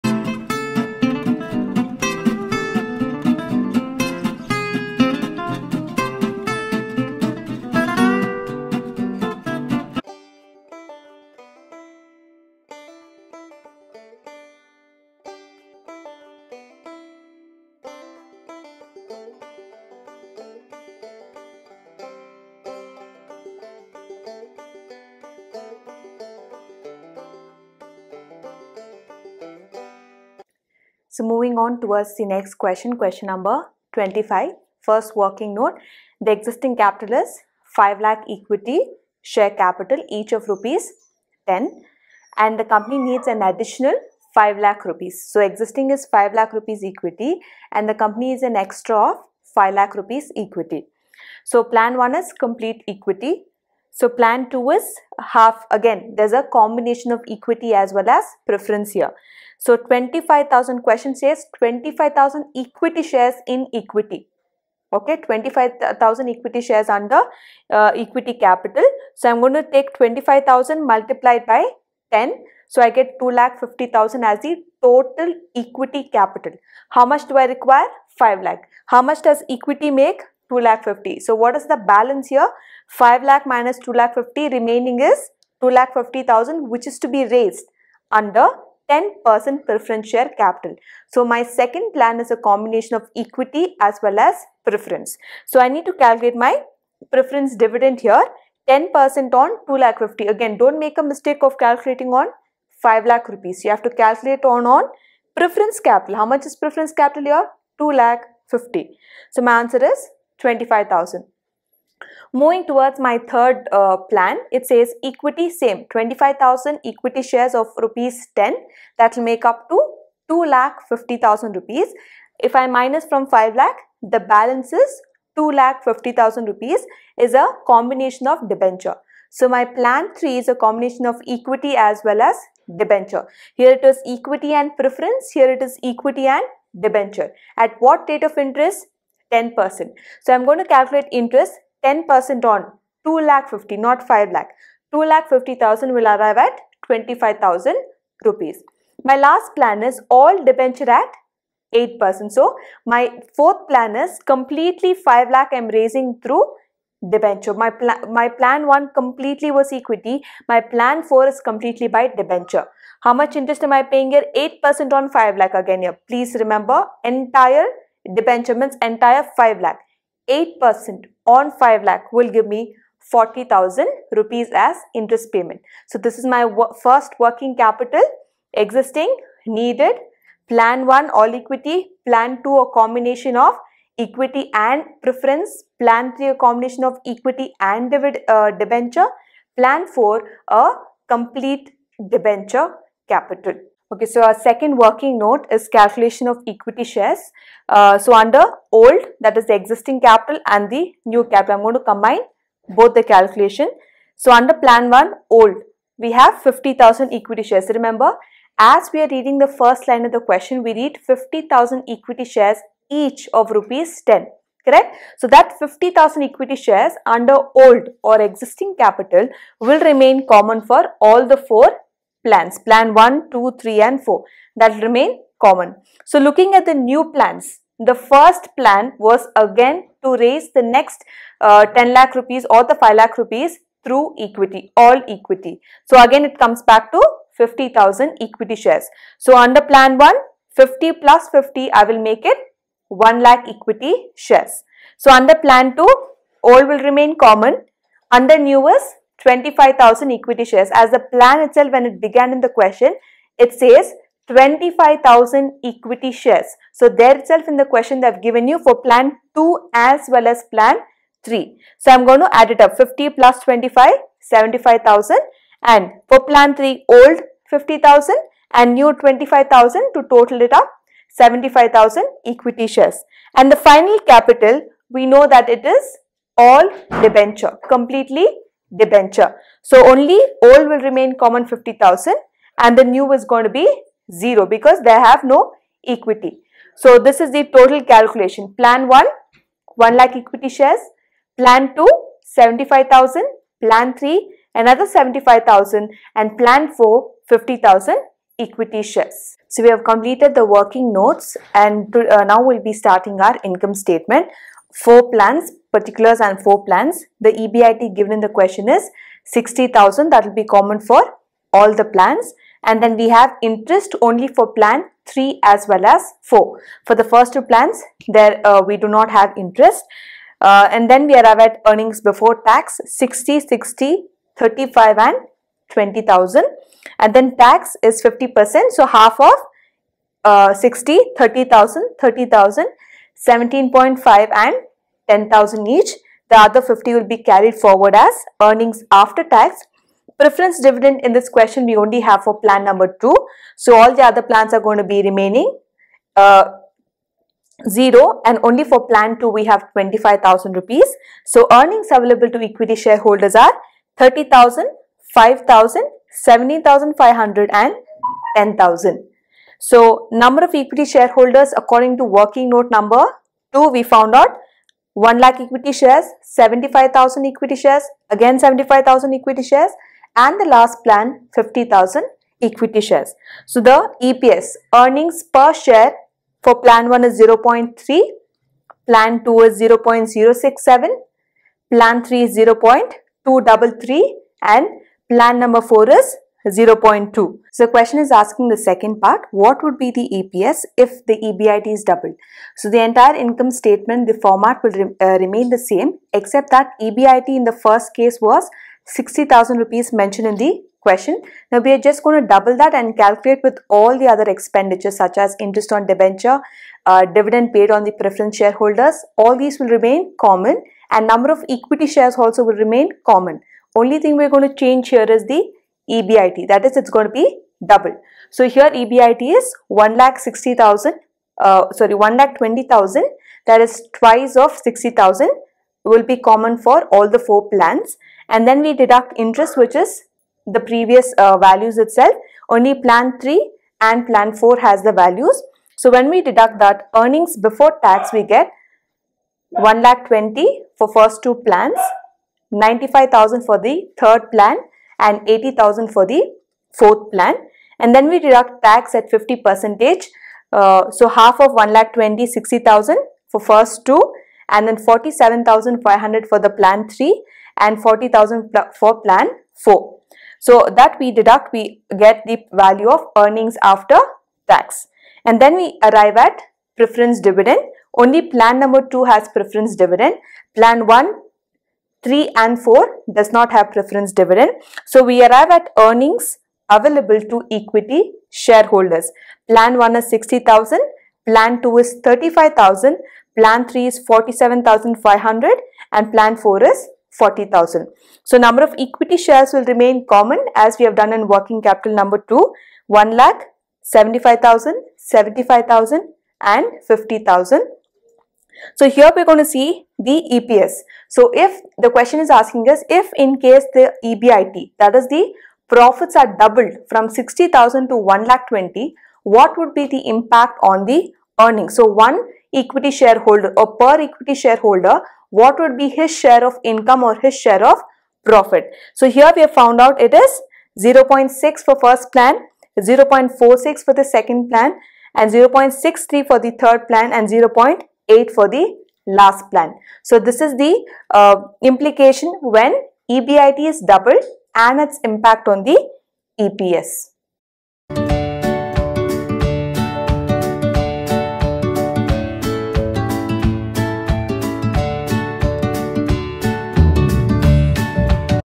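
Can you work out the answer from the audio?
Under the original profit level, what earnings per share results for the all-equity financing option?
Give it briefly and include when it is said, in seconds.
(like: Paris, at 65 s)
0.3, at 377 s.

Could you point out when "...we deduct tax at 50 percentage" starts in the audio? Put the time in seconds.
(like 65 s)
448 s.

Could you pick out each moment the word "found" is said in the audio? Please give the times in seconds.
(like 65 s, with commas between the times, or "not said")
363 s, 519 s.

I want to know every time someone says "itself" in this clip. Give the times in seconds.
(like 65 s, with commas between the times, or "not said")
251 s, 257 s, 431 s.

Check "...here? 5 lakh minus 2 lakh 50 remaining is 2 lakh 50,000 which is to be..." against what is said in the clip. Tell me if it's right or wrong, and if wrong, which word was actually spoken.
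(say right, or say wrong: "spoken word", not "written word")
right.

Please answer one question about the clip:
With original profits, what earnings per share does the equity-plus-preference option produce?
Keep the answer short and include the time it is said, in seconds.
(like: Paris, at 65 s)
0.067, at 379 s.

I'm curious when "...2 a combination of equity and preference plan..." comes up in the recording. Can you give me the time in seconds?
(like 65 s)
182 s.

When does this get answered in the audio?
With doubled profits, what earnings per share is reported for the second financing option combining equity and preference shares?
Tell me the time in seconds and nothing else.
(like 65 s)
522 s.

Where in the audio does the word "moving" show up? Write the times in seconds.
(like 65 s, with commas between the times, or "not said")
31 s, 112 s.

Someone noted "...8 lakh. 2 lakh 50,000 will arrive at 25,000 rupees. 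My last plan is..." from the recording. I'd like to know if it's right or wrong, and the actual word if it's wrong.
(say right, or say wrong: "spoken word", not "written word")
wrong: "5", not "8".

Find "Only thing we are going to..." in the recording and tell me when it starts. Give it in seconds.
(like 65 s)
413 s.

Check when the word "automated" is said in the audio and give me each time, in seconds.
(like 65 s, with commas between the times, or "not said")
not said.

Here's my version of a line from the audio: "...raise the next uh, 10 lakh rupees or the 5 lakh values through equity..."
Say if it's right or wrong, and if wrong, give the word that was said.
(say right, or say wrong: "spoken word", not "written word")
wrong: "rupees", not "values".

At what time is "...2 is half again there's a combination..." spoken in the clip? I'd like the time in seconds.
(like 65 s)
54 s.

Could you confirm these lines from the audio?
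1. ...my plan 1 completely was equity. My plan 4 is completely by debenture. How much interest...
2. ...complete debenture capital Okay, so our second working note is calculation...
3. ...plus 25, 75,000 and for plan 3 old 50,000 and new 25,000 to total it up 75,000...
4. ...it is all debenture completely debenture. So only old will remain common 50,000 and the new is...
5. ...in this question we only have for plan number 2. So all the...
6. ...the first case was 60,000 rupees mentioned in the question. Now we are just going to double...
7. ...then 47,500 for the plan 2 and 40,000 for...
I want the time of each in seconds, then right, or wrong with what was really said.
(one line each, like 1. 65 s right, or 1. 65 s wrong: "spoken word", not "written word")
1. 158 s right
2. 191 s right
3. 263 s right
4. 275 s right
5. 341 s right
6. 397 s right
7. 454 s wrong: "3", not "2".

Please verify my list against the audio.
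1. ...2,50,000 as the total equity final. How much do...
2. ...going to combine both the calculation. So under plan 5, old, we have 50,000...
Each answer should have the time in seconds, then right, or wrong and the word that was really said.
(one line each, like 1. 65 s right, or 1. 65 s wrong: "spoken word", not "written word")
1. 73 s wrong: "capital", not "final"
2. 201 s wrong: "1", not "5".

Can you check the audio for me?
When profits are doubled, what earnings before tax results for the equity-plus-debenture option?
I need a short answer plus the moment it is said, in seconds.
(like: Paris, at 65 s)
95,000, at 442 s.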